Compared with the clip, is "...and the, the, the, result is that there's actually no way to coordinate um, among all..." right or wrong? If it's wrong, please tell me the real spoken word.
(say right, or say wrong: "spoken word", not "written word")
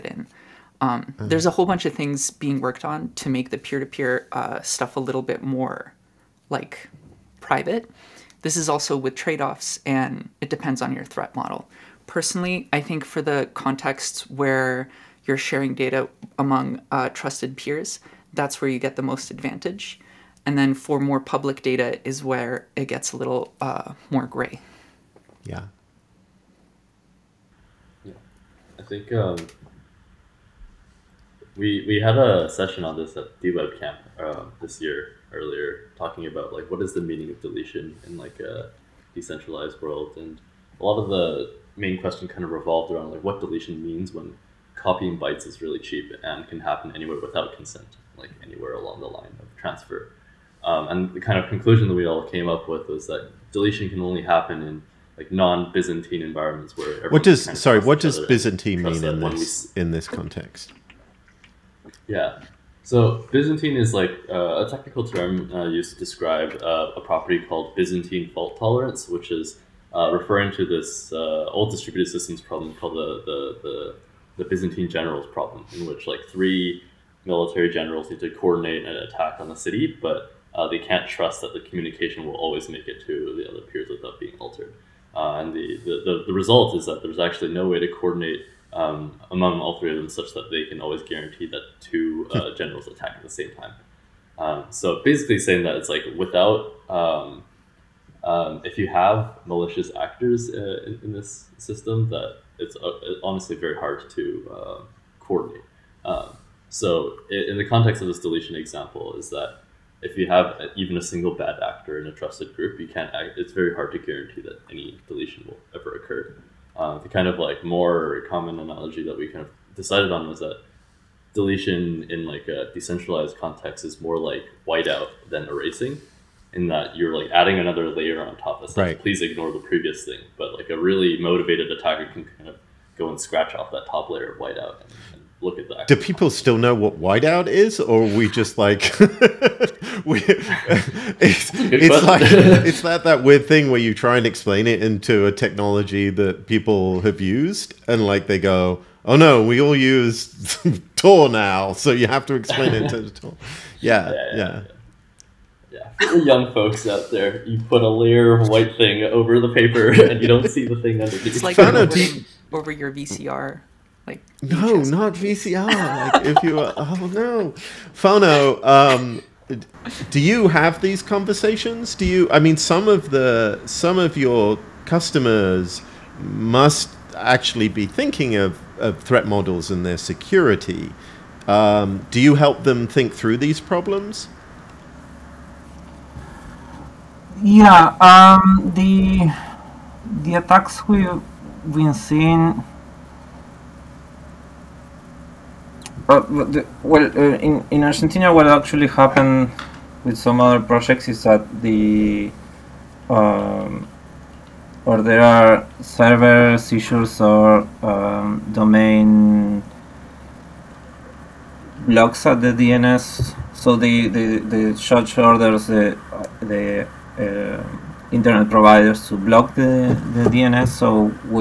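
right.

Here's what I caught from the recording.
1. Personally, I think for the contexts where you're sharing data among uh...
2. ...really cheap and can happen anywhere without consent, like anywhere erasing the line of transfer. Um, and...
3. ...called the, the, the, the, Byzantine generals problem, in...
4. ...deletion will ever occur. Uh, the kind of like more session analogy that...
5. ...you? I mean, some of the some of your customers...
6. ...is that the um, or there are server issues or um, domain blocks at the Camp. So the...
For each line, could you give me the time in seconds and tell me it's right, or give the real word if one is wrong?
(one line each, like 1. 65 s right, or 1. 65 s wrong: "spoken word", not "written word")
1. 12 s right
2. 45 s wrong: "along", not "erasing"
3. 72 s right
4. 115 s wrong: "common", not "session"
5. 172 s right
6. 201 s wrong: "DNS", not "Camp".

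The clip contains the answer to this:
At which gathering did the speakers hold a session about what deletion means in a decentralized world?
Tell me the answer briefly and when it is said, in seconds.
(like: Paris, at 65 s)
DWeb Camp, at 33 s.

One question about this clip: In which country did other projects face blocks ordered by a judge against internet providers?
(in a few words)
Argentina.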